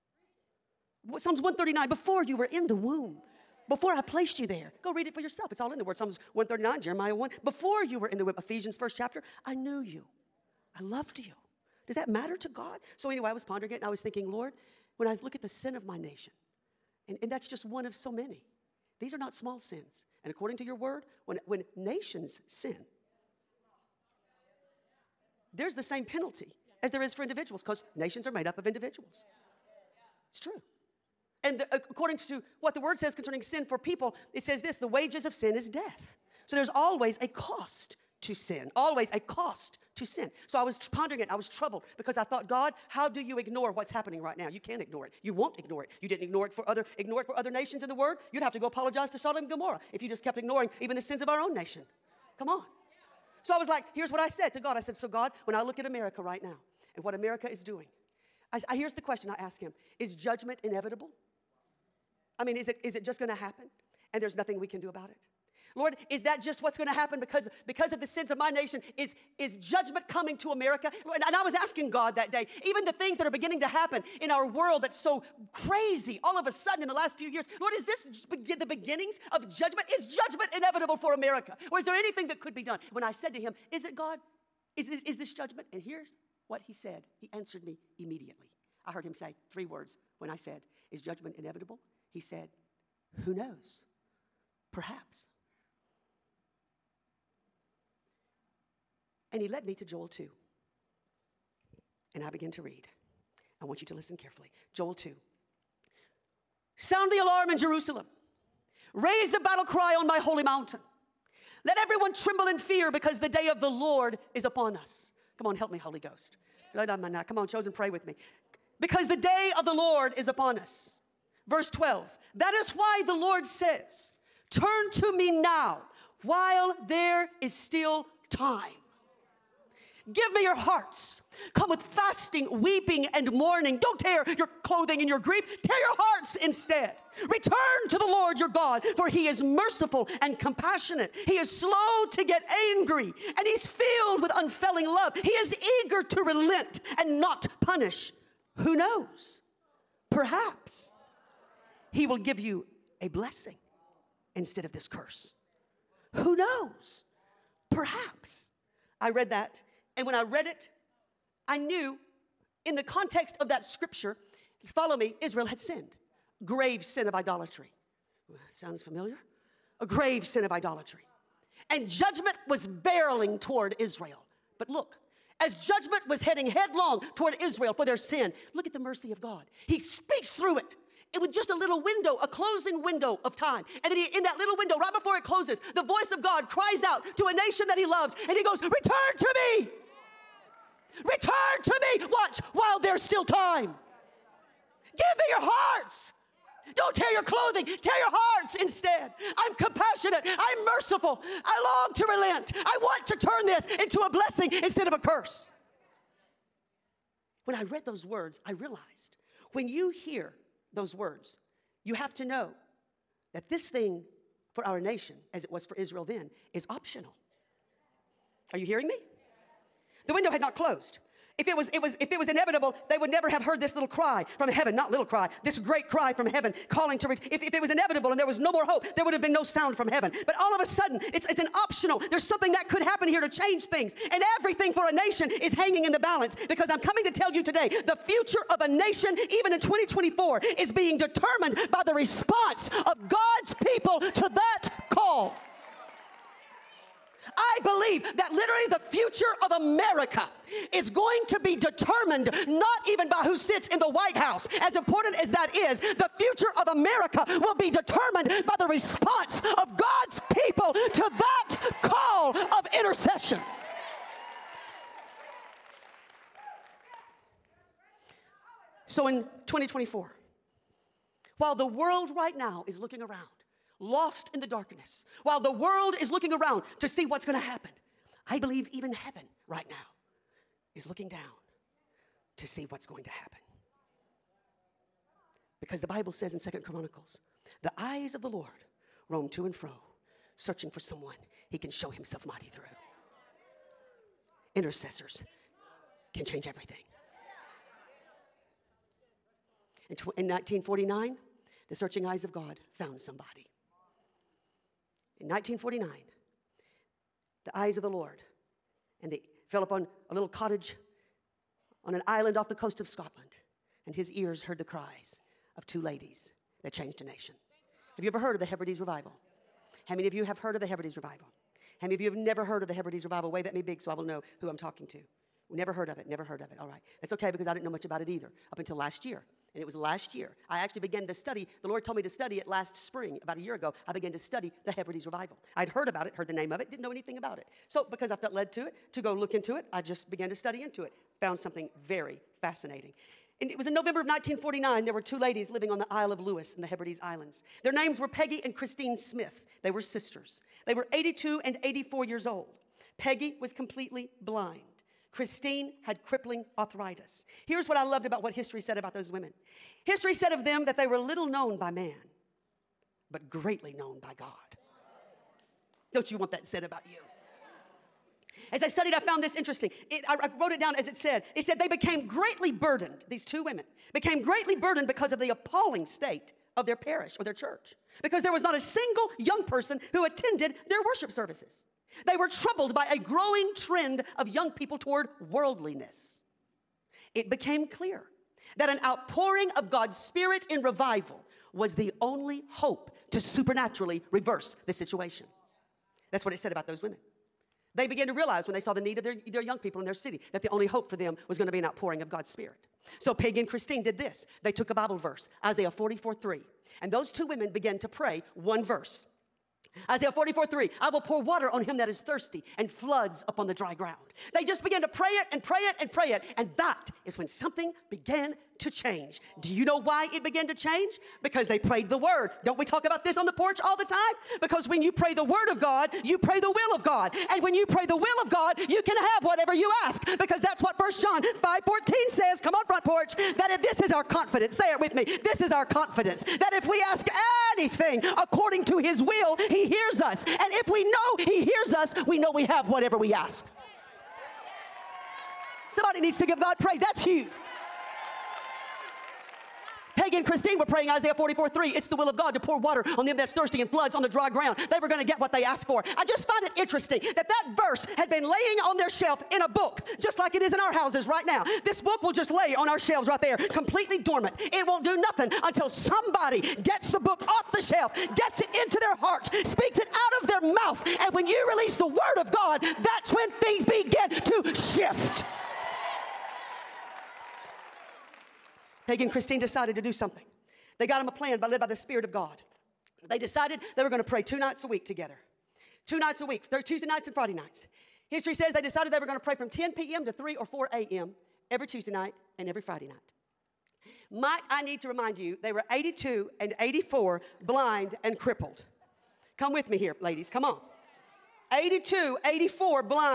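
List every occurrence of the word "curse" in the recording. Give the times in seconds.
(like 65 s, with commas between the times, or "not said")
154 s, 204 s.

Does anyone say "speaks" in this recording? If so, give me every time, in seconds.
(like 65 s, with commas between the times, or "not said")
179 s, 469 s.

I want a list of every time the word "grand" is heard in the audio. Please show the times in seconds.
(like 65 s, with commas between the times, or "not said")
not said.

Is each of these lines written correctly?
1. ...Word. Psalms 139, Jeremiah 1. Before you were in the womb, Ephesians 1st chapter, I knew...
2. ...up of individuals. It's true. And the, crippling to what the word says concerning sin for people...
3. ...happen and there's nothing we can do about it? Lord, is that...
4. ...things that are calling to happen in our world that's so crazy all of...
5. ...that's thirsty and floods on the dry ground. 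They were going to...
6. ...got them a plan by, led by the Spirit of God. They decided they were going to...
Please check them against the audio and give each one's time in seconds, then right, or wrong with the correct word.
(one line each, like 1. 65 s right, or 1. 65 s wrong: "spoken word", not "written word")
1. 5 s right
2. 28 s wrong: "according", not "crippling"
3. 63 s right
4. 72 s wrong: "beginning", not "calling"
5. 453 s right
6. 480 s right.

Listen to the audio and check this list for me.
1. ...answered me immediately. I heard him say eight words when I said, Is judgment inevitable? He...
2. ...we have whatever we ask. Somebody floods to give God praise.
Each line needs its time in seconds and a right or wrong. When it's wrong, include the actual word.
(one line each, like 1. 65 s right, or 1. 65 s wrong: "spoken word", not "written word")
1. 87 s wrong: "three", not "eight"
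2. 442 s wrong: "needs", not "floods".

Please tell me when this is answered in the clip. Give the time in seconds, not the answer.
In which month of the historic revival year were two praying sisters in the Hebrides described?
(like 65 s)
343 s.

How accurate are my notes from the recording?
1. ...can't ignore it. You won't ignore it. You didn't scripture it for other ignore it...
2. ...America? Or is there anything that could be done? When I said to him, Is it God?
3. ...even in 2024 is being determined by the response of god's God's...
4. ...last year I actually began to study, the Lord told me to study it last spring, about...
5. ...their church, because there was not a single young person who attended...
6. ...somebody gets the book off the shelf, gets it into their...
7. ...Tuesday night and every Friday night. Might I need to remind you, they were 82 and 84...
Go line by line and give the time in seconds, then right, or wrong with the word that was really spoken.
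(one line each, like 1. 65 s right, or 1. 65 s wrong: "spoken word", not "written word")
1. 44 s wrong: "ignore", not "scripture"
2. 81 s right
3. 239 s right
4. 329 s right
5. 377 s right
6. 465 s right
7. 491 s right.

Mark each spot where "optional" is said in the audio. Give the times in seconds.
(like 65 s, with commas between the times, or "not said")
216 s, 231 s.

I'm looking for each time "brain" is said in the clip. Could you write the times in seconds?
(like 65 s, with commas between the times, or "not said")
not said.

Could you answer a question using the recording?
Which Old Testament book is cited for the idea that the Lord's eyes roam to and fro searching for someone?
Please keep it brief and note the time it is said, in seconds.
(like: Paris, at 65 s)
Second Chronicles, at 286 s.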